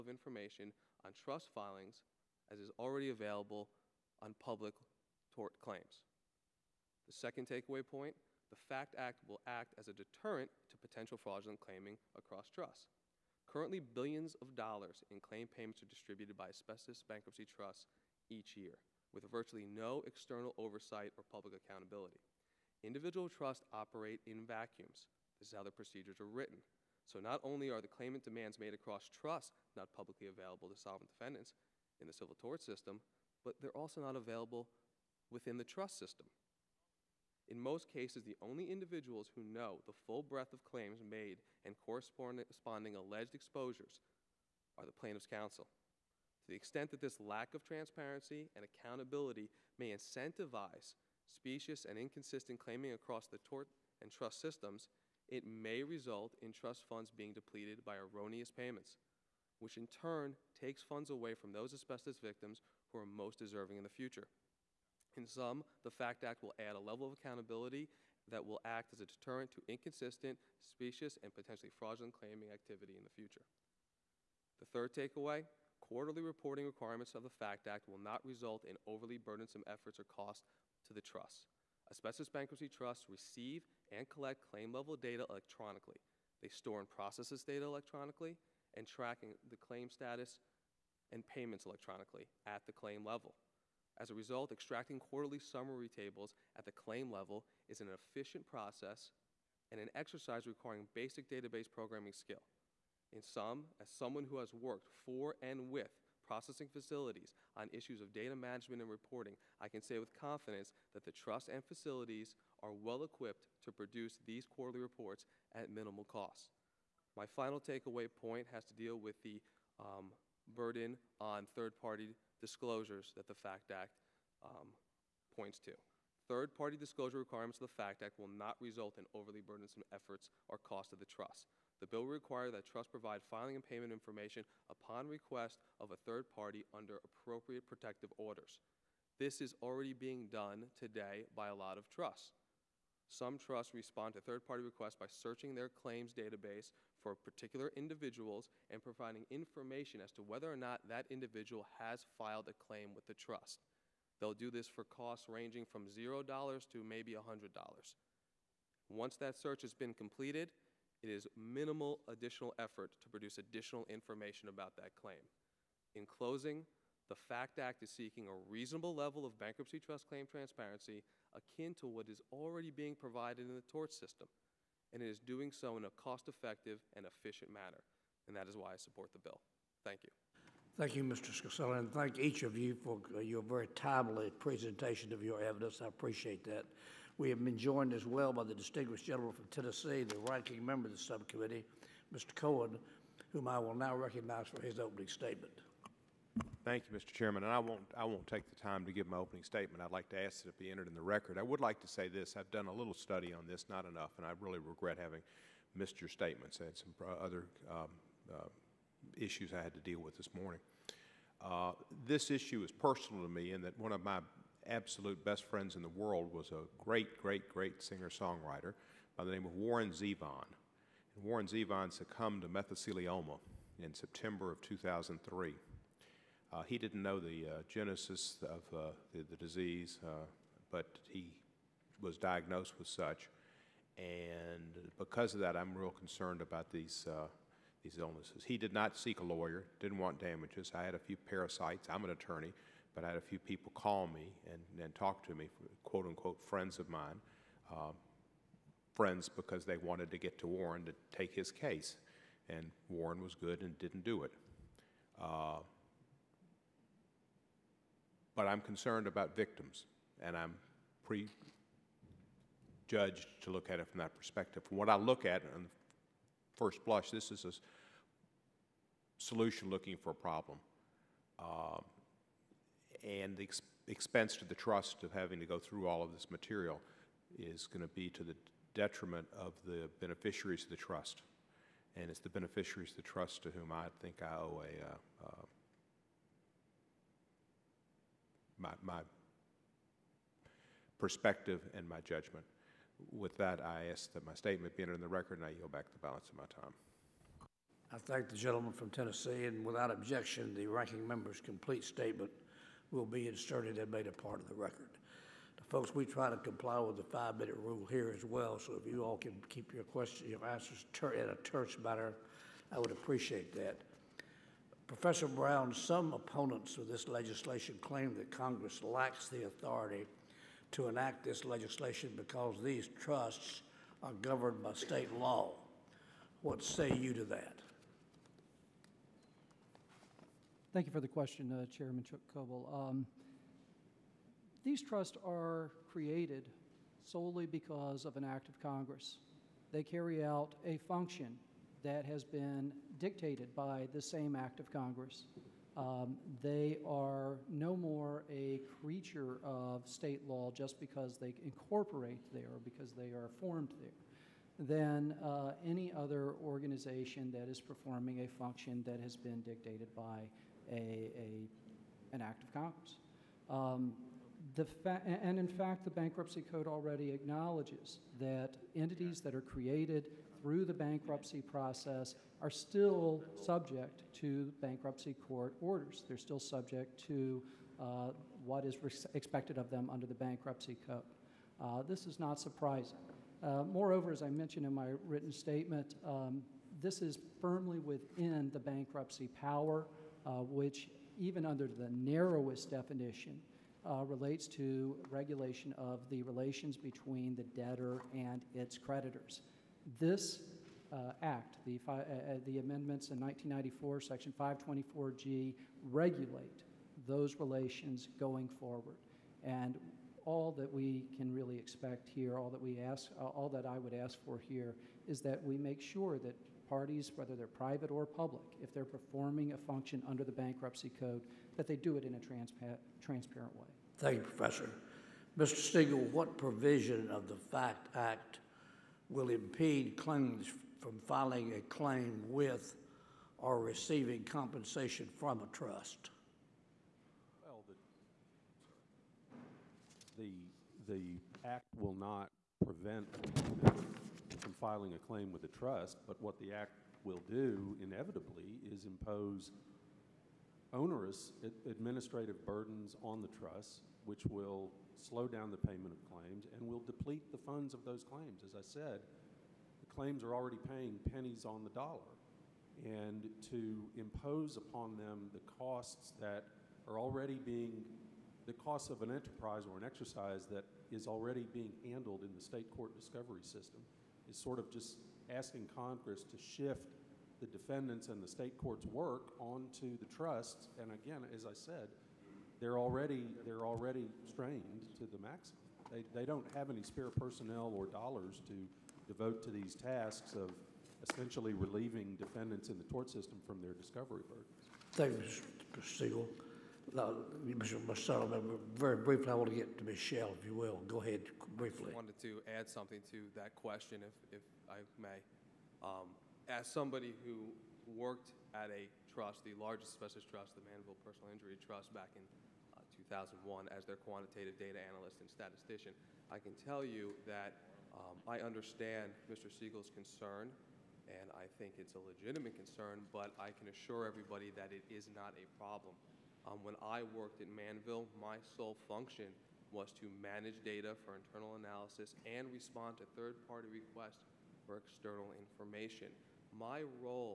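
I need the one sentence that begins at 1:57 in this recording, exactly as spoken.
My final takeaway point has to deal with the um, burden on third-party disclosures that the FACT Act um, points to.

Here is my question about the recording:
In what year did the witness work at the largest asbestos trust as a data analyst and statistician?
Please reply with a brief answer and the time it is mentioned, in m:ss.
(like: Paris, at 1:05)
2001, at 8:33.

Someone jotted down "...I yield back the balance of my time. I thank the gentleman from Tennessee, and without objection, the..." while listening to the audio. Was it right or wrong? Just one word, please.
right.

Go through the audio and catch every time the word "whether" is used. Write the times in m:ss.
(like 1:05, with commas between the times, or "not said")
2:30, 6:57.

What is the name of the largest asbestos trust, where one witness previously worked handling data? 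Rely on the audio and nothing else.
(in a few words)
Manville Personal Injury Trust.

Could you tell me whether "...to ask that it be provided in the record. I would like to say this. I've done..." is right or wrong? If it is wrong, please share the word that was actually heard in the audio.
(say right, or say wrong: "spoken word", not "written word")
wrong: "entered", not "provided".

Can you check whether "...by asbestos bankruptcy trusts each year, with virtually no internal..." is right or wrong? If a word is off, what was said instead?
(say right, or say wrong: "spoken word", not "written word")
wrong: "external", not "internal".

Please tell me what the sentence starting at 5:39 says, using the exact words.
They carry out a function that has been dictated by the same act of Congress.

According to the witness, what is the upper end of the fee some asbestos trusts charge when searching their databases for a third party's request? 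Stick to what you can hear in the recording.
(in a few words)
$100.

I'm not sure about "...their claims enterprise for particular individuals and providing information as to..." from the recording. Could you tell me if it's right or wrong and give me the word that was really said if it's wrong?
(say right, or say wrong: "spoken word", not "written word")
wrong: "database", not "enterprise".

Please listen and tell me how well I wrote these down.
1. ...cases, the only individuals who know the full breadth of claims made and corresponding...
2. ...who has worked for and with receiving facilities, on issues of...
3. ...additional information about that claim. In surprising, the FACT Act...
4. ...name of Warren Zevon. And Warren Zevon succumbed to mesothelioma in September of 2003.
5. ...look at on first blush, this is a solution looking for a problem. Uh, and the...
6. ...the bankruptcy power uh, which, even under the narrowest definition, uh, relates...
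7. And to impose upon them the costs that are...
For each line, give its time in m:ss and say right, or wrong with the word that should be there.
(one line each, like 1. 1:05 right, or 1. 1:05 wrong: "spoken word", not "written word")
1. 0:37 right
2. 1:44 wrong: "processing", not "receiving"
3. 2:43 wrong: "closing", not "surprising"
4. 3:39 right
5. 4:24 right
6. 6:28 right
7. 7:42 right.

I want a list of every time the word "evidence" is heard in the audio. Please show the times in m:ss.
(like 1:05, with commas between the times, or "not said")
3:05.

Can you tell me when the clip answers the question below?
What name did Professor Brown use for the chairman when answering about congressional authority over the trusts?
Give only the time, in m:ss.
5:32.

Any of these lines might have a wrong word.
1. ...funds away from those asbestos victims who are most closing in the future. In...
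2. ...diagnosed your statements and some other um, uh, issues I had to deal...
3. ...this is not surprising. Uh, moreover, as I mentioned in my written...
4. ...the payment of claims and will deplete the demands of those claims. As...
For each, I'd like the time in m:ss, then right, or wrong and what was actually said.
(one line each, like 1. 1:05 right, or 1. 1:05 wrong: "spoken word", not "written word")
1. 1:00 wrong: "deserving", not "closing"
2. 3:25 wrong: "missed", not "diagnosed"
3. 6:21 right
4. 7:35 wrong: "funds", not "demands".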